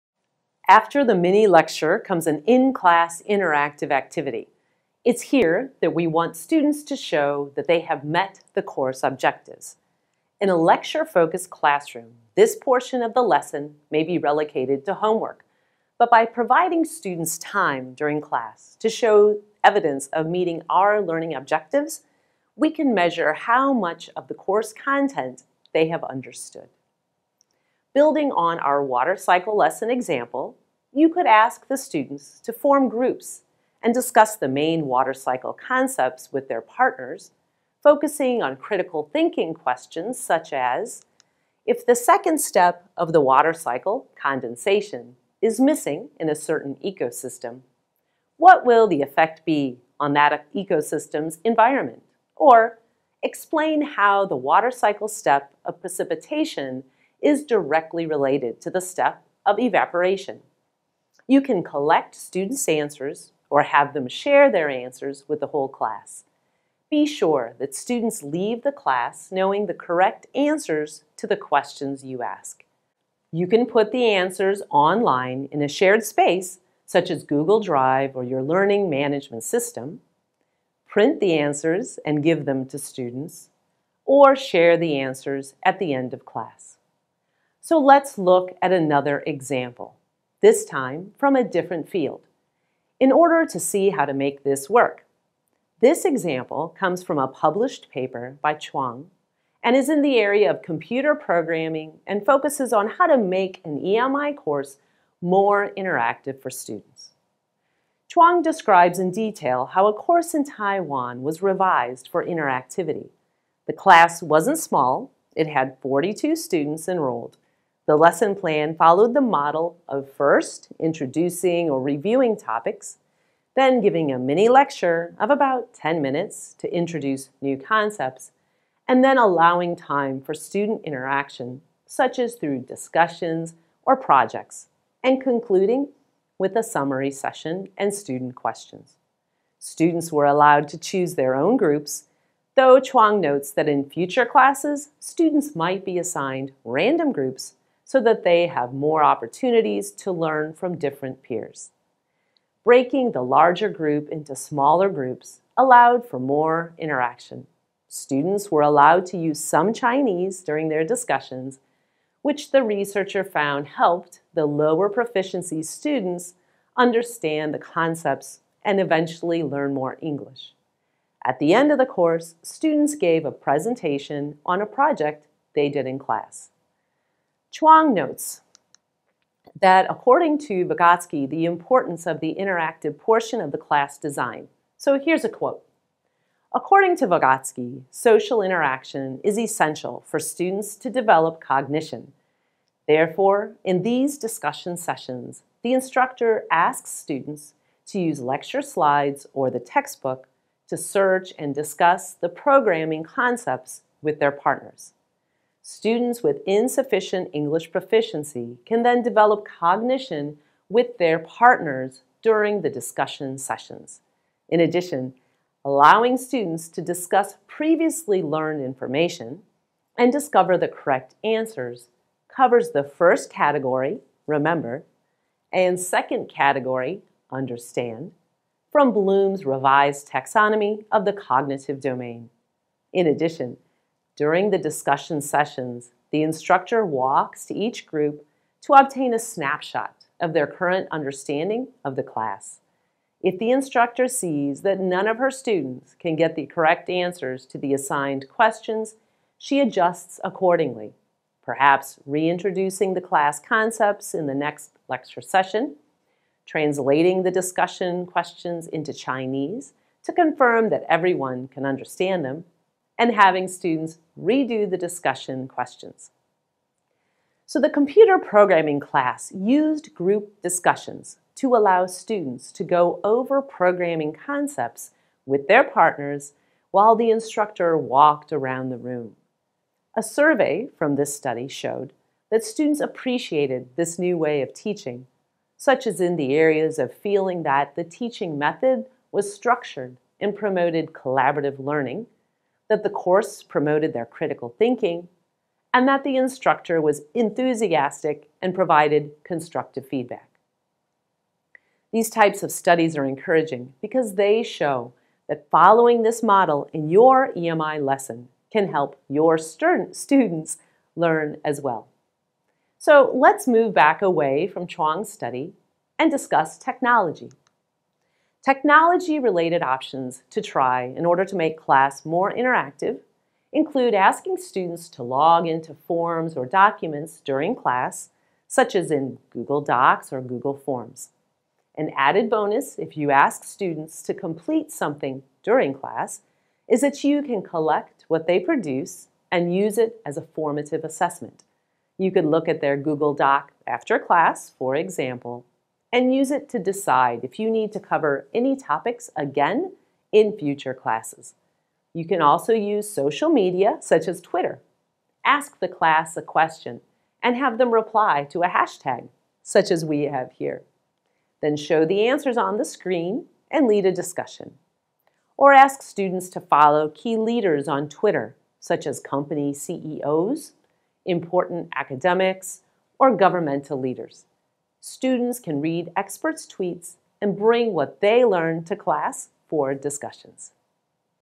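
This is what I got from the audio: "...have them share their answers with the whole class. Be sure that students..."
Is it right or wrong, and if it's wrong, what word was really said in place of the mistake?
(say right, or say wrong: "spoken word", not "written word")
right.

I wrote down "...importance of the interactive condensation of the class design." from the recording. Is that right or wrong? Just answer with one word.
wrong.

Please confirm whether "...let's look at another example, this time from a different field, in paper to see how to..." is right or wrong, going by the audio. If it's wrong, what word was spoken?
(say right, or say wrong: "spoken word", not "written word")
wrong: "order", not "paper".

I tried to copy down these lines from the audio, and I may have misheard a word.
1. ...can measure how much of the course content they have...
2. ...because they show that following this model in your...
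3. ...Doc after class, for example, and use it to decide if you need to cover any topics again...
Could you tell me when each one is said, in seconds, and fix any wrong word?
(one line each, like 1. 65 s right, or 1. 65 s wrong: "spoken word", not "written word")
1. 22 s right
2. 303 s right
3. 343 s right.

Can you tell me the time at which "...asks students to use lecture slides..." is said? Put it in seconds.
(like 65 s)
196 s.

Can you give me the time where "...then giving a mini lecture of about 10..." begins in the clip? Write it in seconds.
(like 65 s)
123 s.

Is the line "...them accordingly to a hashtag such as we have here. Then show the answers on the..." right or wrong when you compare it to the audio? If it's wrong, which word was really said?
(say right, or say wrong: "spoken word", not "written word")
wrong: "reply", not "accordingly".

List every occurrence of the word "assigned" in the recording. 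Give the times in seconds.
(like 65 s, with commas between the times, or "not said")
145 s, 247 s.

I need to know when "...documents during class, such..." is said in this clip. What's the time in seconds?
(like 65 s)
326 s.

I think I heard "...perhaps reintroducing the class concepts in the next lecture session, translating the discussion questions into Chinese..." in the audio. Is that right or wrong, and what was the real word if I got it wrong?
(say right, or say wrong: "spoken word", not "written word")
right.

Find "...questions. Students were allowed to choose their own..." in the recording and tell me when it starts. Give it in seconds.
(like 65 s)
138 s.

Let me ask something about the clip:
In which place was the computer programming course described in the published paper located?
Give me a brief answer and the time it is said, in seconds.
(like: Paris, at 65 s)
Taiwan, at 110 s.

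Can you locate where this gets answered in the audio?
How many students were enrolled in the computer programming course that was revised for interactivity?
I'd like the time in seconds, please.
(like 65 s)
115 s.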